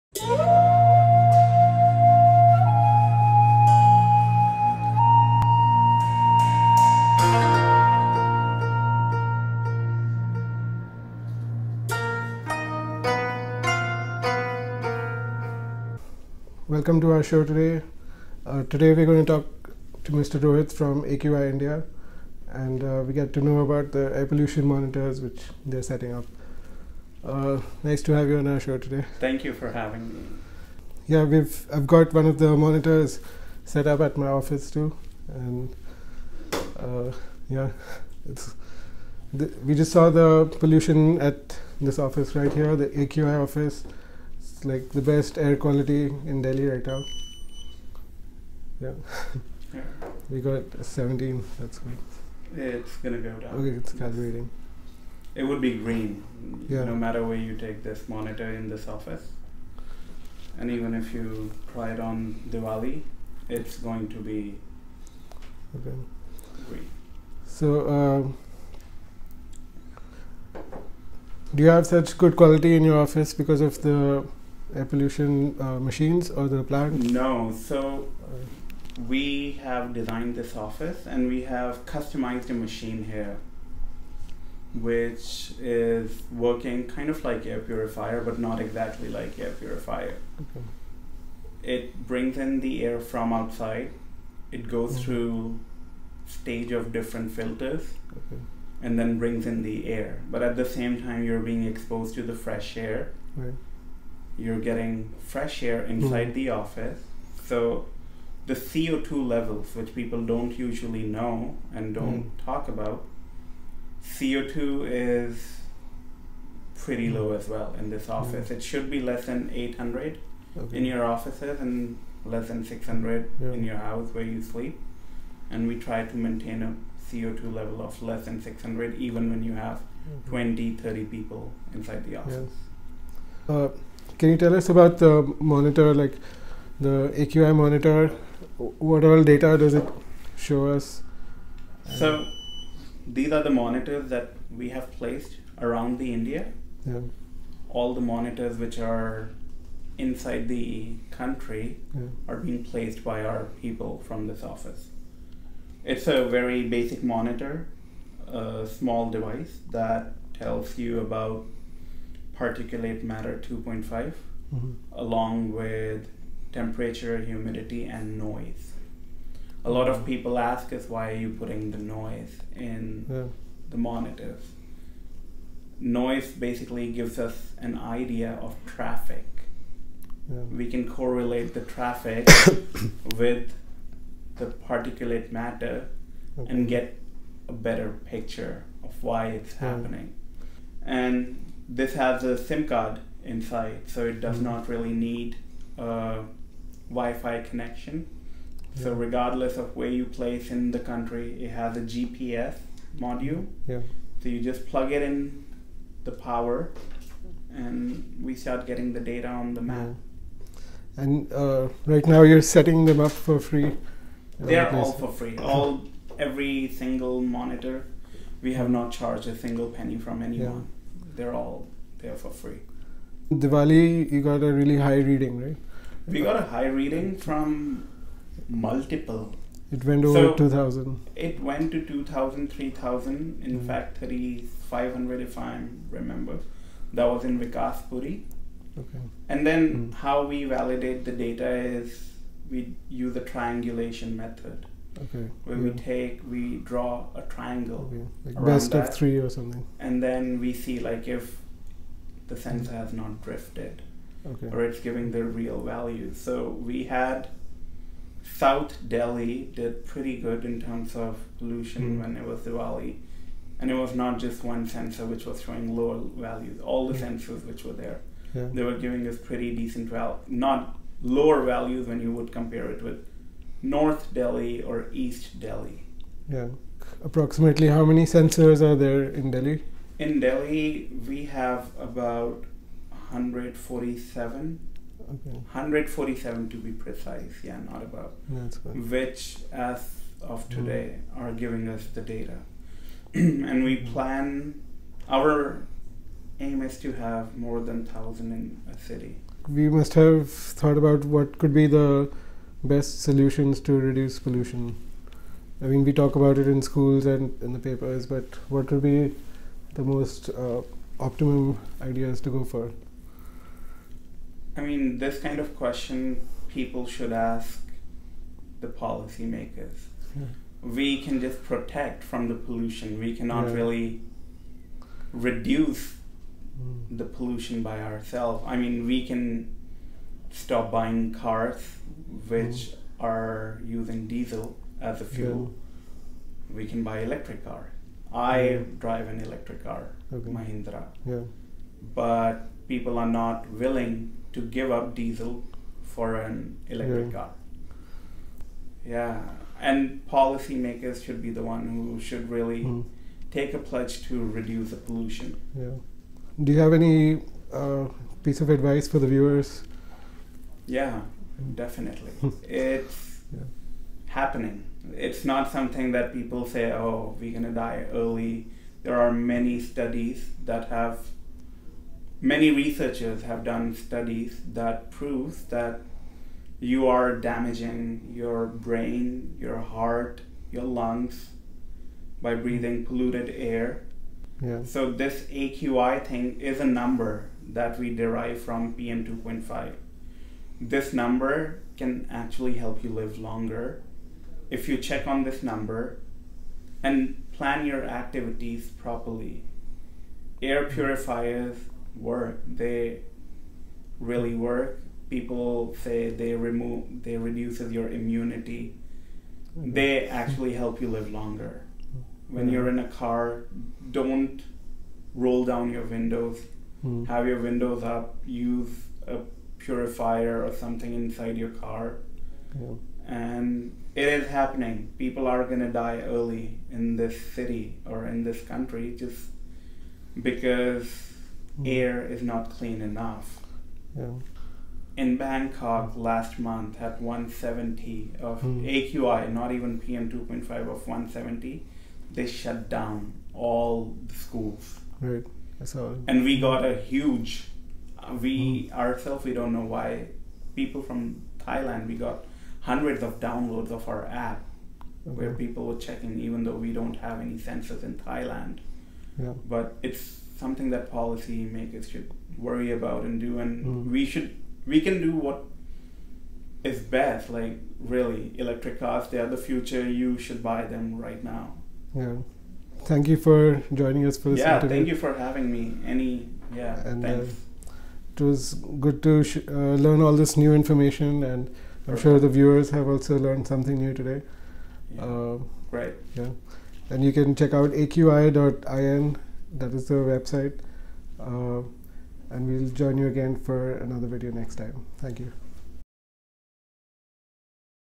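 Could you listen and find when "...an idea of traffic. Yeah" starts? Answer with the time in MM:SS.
02:57.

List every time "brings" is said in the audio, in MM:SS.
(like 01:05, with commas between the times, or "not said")
01:32, 01:39.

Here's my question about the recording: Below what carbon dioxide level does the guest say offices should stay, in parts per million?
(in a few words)
800.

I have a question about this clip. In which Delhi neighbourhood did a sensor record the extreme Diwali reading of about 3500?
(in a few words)
Vikaspuri.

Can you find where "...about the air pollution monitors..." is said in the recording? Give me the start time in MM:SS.
00:23.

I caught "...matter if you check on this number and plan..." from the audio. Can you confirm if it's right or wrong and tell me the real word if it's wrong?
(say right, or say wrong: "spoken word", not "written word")
wrong: "longer", not "matter".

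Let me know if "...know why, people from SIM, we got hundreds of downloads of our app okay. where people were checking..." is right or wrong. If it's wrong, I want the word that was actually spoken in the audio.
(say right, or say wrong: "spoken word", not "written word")
wrong: "Thailand", not "SIM".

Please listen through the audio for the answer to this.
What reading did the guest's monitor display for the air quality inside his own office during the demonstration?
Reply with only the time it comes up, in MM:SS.
00:50.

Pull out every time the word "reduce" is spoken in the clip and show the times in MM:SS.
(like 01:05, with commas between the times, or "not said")
05:03, 05:25, 05:54, 06:47.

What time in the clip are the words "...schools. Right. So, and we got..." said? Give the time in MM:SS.
07:24.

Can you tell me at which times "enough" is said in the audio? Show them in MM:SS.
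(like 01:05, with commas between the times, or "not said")
07:12.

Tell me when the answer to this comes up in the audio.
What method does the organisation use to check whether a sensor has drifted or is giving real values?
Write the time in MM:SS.
04:03.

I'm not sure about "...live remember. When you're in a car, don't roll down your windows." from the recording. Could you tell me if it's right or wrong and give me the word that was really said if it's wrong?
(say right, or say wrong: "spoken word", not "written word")
wrong: "longer", not "remember".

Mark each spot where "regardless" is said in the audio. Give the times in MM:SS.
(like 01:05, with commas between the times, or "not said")
03:18.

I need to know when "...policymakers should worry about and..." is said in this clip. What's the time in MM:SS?
07:40.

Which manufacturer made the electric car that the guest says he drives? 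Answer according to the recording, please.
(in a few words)
Mahindra.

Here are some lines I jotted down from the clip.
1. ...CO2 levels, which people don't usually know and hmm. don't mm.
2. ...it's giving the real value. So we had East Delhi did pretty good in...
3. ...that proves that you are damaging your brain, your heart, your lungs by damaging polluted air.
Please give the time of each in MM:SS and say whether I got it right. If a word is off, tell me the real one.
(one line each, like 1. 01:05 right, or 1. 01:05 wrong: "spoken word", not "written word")
1. 01:48 right
2. 04:14 wrong: "South", not "East"
3. 06:14 wrong: "breathing", not "damaging".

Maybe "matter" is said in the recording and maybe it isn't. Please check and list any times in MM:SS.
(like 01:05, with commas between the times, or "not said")
00:56, 02:43, 03:05.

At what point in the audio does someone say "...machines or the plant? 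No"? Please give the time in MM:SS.
01:15.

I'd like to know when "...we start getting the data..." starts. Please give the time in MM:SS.
03:28.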